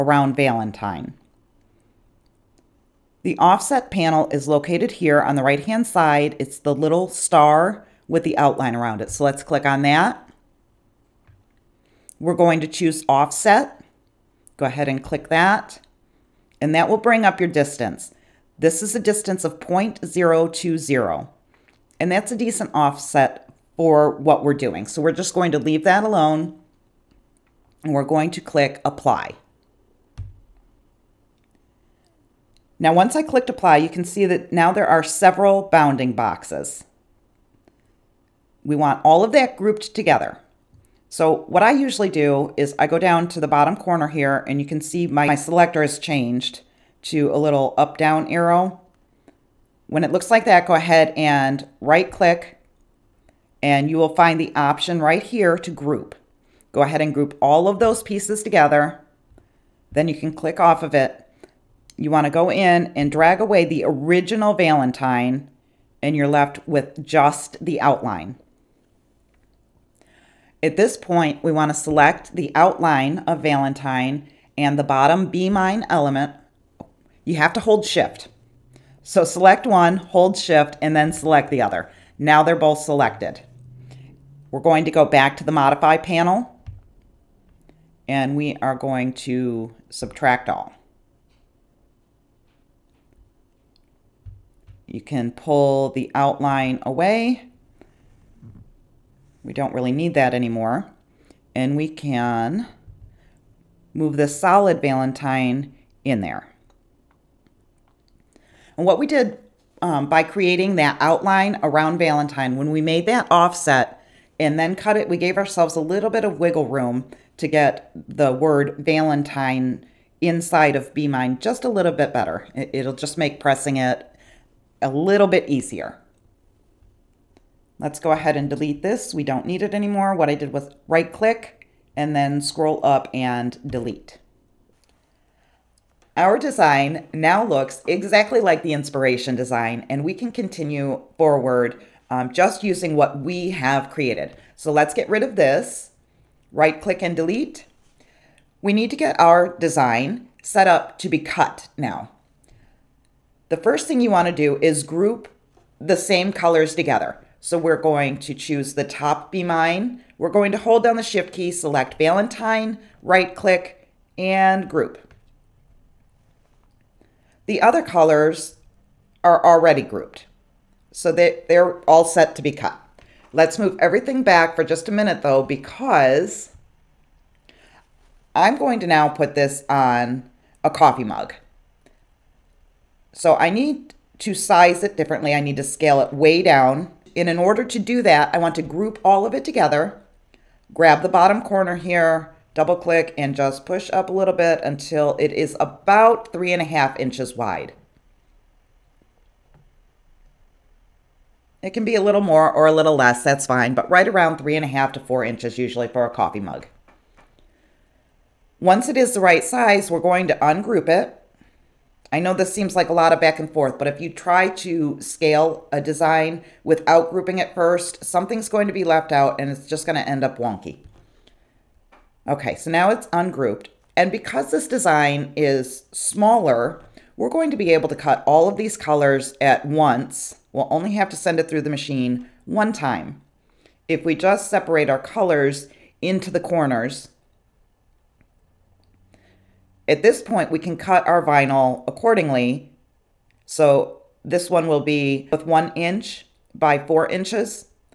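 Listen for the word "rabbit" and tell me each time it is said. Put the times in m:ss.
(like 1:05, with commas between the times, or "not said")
not said.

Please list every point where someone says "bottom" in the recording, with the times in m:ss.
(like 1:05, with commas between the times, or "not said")
0:43, 1:14, 3:11.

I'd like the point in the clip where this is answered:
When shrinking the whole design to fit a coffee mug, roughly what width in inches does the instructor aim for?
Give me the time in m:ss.
3:16.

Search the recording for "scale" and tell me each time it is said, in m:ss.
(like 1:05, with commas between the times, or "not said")
3:05, 3:34.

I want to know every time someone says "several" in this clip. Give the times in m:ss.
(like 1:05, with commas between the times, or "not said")
0:35.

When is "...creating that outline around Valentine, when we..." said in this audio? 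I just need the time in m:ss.
1:50.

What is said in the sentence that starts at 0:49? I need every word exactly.
When it looks like that, go ahead and right click and you will find the option right here to group.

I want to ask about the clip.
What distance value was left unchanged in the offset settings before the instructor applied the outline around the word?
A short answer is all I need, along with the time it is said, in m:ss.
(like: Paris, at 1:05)
0.020, at 0:19.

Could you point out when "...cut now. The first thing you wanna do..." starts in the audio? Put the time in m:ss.
2:31.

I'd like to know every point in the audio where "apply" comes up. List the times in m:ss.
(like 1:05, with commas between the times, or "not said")
0:28, 0:33.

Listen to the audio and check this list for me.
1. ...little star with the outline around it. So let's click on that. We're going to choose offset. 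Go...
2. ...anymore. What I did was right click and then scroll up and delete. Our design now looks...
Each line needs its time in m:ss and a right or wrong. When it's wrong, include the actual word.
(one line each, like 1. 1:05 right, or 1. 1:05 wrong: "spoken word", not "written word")
1. 0:06 right
2. 2:09 right.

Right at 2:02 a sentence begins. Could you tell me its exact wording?
It'll just make pressing it a little bit easier.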